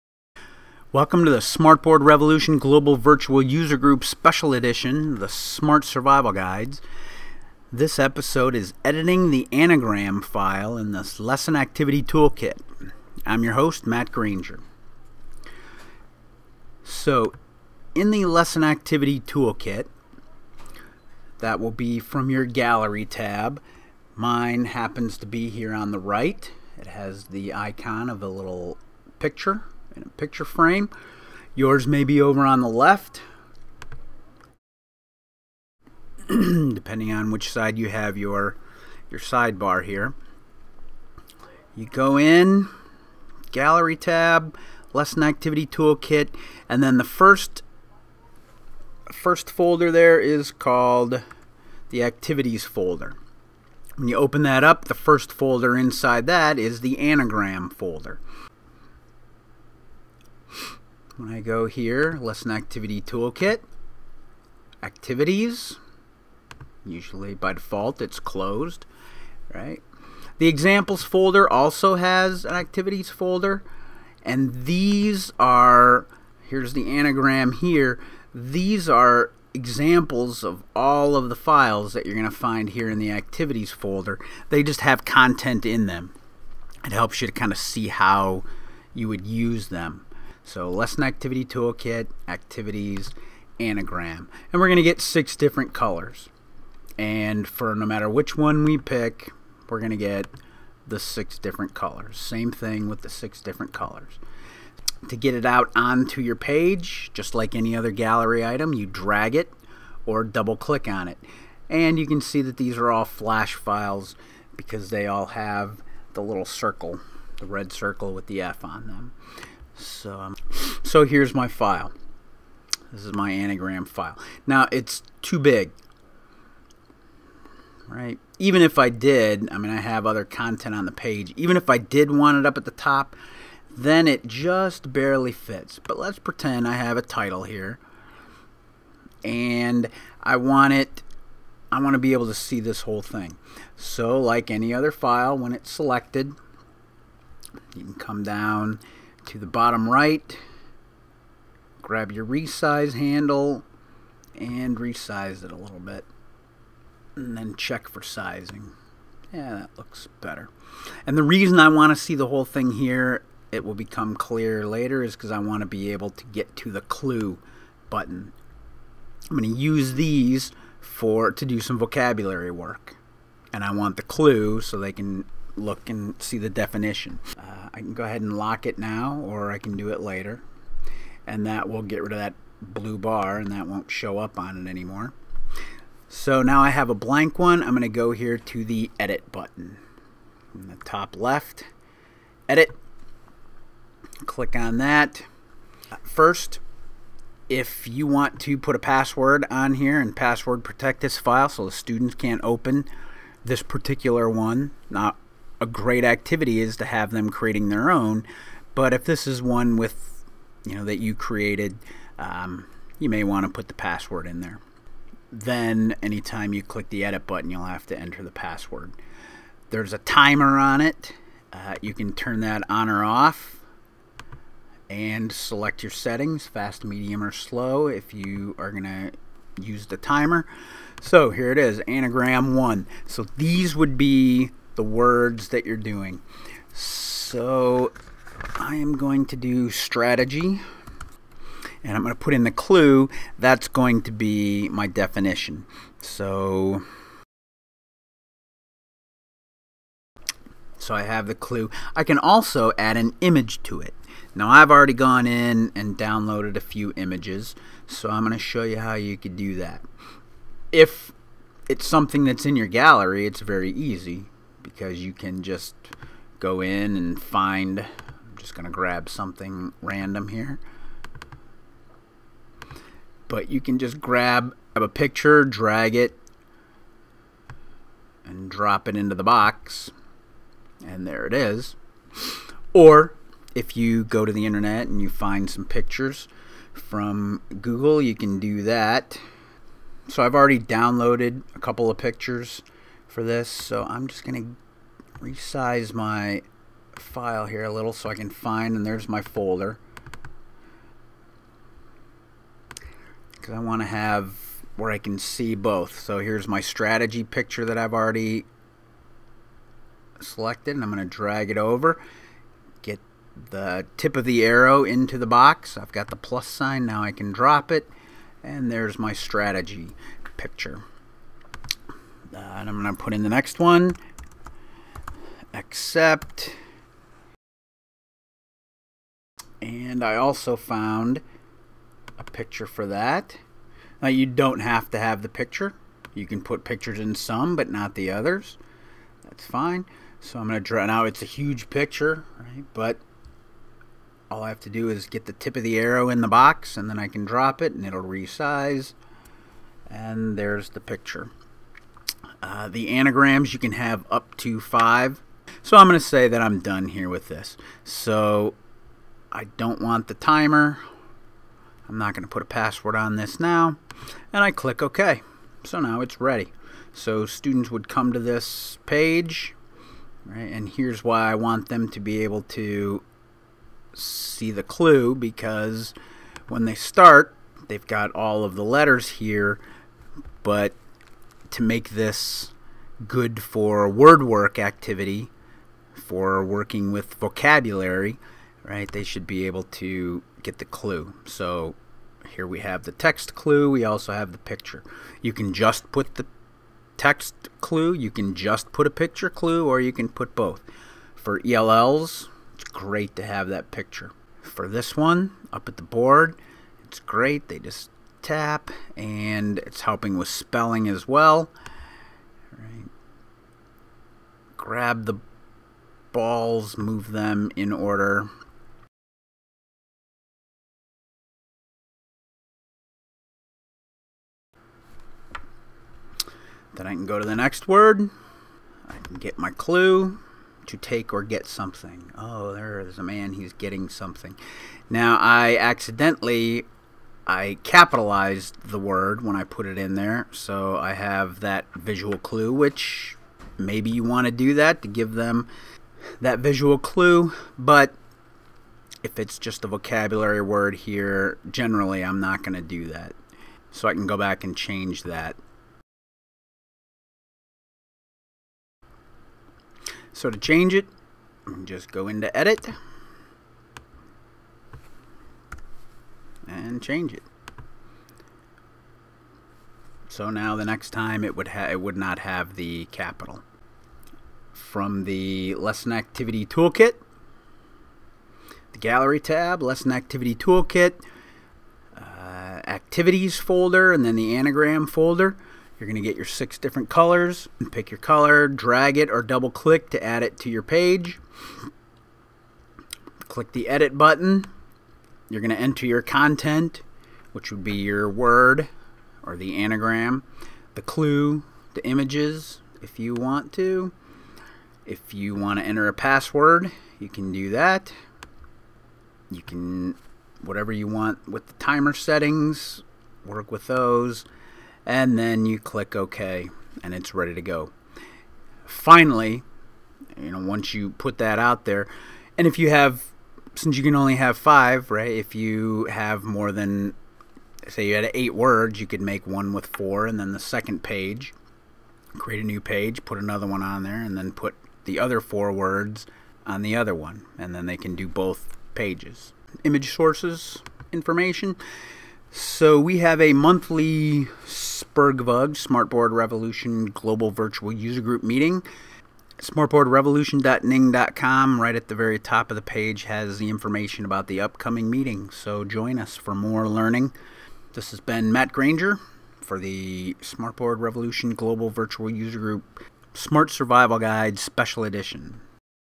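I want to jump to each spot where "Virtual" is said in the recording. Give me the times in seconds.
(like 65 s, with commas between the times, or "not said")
2 s, 547 s, 561 s.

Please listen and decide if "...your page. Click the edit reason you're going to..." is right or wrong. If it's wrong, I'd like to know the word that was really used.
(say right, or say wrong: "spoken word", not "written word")
wrong: "button", not "reason".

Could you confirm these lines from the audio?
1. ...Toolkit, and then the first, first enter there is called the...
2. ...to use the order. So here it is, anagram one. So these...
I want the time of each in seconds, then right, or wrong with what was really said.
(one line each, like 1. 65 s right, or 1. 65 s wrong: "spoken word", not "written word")
1. 45 s wrong: "folder", not "enter"
2. 228 s wrong: "timer", not "order".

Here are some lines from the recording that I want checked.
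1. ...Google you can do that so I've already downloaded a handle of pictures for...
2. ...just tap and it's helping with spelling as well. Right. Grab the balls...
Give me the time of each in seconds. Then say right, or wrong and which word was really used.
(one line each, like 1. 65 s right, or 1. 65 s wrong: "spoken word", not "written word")
1. 287 s wrong: "couple", not "handle"
2. 407 s right.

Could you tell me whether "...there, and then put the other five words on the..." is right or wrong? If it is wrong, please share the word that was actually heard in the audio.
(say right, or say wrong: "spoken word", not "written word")
wrong: "four", not "five".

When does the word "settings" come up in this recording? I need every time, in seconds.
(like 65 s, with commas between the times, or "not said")
225 s, 511 s.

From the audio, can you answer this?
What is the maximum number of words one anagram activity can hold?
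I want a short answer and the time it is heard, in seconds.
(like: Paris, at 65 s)
5, at 354 s.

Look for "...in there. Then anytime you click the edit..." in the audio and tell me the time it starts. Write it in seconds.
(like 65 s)
214 s.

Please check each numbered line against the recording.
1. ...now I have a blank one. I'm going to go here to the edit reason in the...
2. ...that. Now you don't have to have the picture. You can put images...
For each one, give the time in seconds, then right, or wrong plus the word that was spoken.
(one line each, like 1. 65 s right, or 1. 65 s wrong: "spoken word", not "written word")
1. 186 s wrong: "button", not "reason"
2. 332 s wrong: "pictures", not "images".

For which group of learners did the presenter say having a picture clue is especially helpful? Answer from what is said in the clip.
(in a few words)
ELLs.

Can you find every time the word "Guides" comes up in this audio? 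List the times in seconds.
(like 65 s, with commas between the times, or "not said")
6 s, 563 s.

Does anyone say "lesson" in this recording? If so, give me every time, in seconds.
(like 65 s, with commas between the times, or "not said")
11 s, 18 s, 44 s, 62 s, 90 s, 475 s, 479 s.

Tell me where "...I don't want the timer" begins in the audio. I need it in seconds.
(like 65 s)
359 s.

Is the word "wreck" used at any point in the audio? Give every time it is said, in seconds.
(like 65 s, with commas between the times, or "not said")
not said.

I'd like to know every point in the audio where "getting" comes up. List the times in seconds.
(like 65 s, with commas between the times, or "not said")
433 s.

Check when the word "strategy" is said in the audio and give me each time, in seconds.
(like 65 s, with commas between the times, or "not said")
239 s, 306 s, 319 s.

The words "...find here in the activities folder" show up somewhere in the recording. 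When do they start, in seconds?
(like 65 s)
82 s.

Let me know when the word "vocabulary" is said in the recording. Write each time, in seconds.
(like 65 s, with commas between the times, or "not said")
171 s, 387 s, 449 s.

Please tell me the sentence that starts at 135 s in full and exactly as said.
But let's pretend I have a title here and I want it I want to be able to see this whole thing.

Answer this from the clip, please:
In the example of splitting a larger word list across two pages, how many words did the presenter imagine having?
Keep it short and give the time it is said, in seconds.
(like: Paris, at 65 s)
8, at 528 s.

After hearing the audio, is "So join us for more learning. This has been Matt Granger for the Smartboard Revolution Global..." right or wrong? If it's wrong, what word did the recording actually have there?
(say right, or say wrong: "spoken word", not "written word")
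right.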